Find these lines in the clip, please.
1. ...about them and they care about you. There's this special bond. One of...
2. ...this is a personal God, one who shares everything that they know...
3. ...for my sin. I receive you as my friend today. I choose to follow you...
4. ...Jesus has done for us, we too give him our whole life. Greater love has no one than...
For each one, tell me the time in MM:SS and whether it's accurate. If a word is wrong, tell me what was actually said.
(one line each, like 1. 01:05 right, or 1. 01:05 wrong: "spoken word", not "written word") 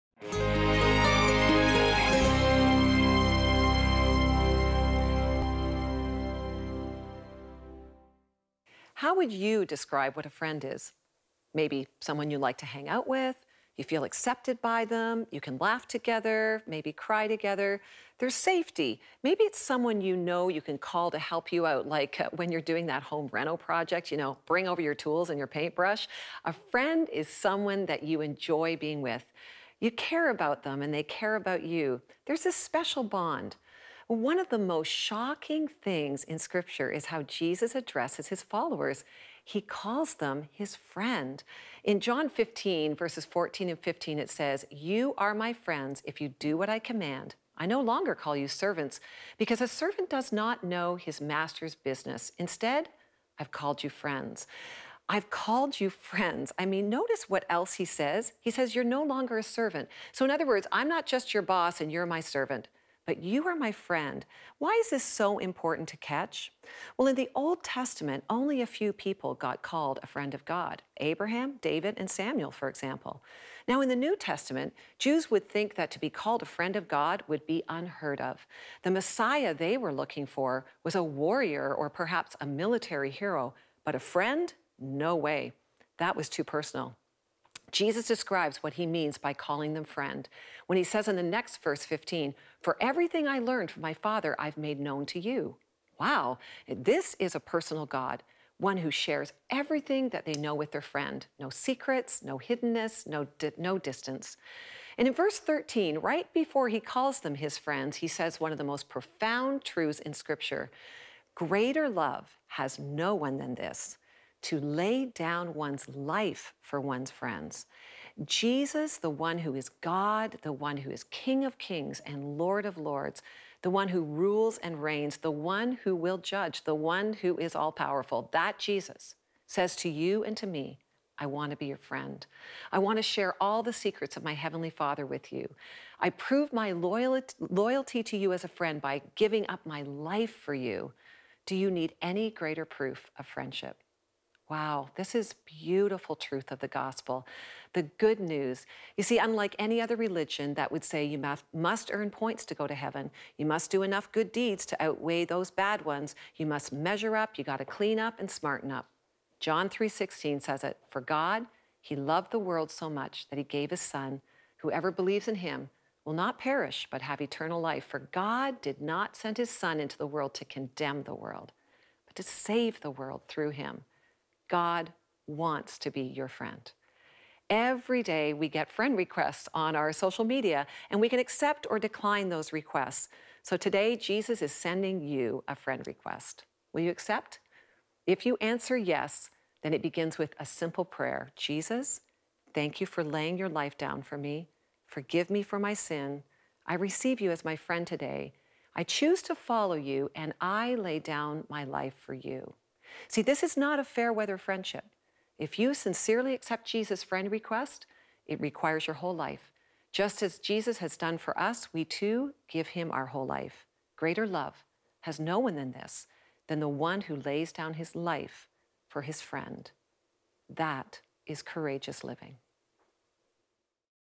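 1. 00:30 right
2. 01:36 right
3. 03:15 right
4. 03:30 right.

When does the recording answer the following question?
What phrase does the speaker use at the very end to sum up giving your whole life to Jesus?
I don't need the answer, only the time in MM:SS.
03:41.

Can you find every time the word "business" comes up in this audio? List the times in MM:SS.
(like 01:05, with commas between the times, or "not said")
00:51.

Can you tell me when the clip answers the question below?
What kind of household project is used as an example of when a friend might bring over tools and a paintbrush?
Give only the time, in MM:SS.
00:23.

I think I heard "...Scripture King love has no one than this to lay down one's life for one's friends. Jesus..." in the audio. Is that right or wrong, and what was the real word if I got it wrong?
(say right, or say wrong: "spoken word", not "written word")
wrong: "Greater", not "King".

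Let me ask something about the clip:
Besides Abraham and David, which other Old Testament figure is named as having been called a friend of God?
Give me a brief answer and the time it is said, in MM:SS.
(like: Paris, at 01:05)
Samuel, at 01:12.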